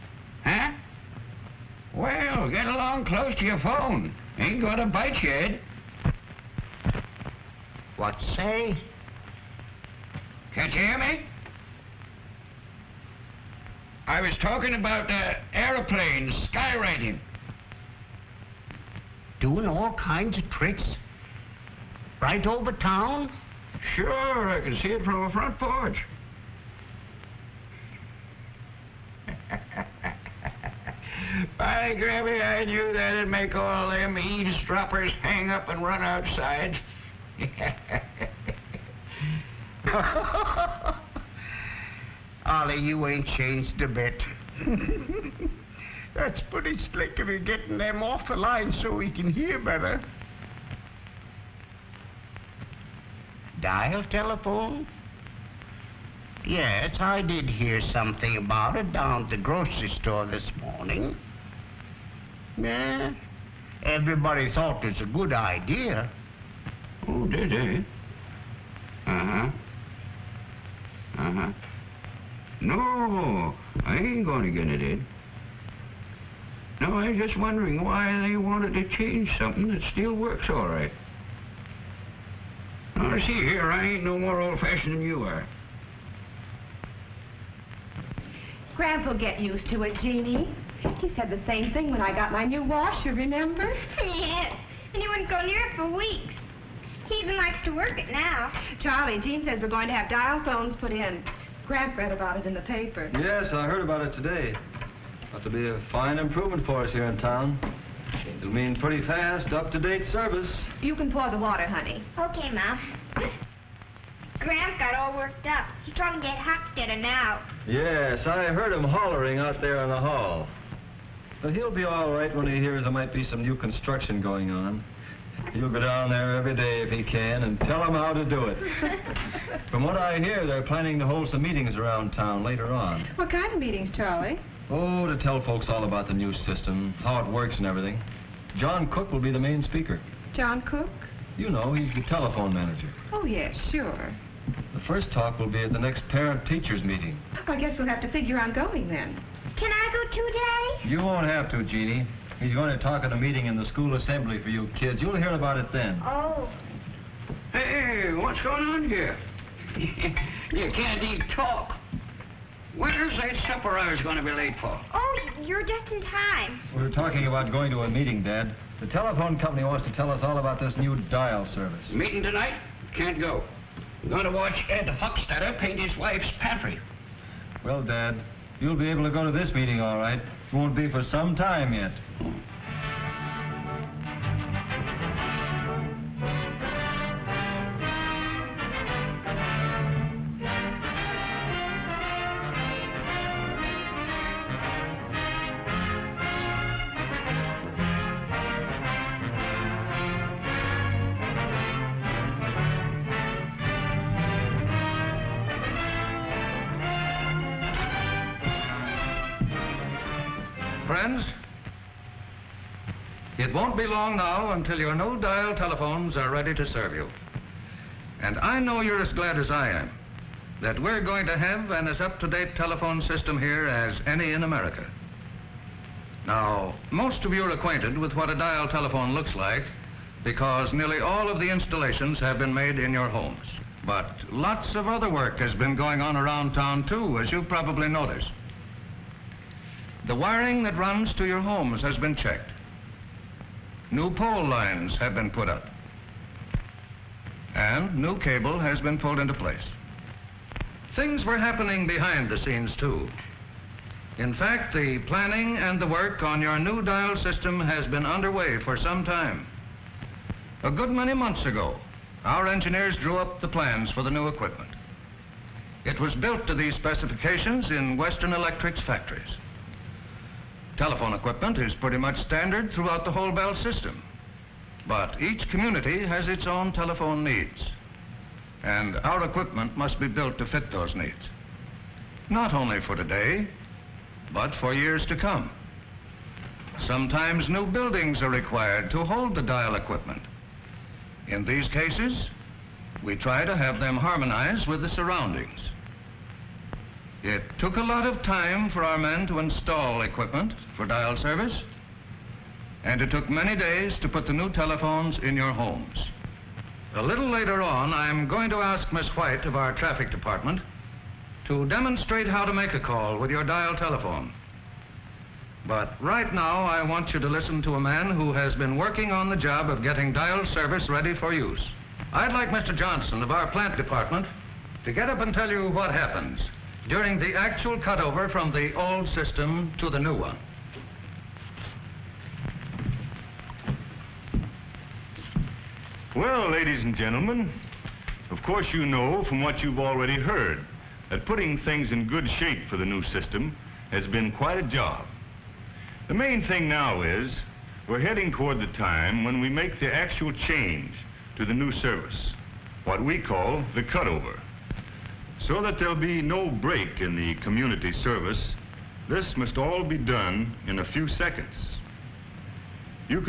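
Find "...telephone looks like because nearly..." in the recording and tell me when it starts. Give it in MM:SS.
03:48.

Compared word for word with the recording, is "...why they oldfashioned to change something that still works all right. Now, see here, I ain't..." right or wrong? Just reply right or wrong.
wrong.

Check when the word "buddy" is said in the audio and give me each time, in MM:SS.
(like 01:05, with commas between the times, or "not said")
not said.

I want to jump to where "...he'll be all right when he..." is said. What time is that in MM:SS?
02:01.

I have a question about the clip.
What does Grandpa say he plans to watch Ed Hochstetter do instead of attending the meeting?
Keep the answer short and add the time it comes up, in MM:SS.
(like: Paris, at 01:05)
Paint his wife's pantry, at 02:55.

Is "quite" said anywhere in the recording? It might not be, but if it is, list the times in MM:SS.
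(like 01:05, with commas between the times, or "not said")
05:44.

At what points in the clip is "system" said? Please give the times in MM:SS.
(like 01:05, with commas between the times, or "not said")
02:16, 03:43, 04:17, 04:33, 05:29, 05:43.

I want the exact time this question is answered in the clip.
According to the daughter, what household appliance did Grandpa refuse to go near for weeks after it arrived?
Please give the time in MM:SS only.
01:32.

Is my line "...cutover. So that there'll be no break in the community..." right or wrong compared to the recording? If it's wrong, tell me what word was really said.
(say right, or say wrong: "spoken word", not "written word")
right.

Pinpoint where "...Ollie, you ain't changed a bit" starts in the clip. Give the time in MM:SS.
00:42.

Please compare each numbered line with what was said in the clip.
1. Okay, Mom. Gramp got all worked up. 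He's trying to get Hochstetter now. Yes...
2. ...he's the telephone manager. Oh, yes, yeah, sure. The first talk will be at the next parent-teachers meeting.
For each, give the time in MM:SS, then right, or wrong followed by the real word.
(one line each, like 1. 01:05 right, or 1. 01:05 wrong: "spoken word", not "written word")
1. 01:52 right
2. 02:21 right.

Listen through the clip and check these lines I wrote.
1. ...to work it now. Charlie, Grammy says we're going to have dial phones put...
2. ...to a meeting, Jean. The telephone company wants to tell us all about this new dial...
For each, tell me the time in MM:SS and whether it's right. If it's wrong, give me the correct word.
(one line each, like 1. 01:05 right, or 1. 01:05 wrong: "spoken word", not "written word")
1. 01:37 wrong: "Jean", not "Grammy"
2. 02:47 wrong: "Dad", not "Jean".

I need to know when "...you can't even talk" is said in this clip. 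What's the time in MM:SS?
02:39.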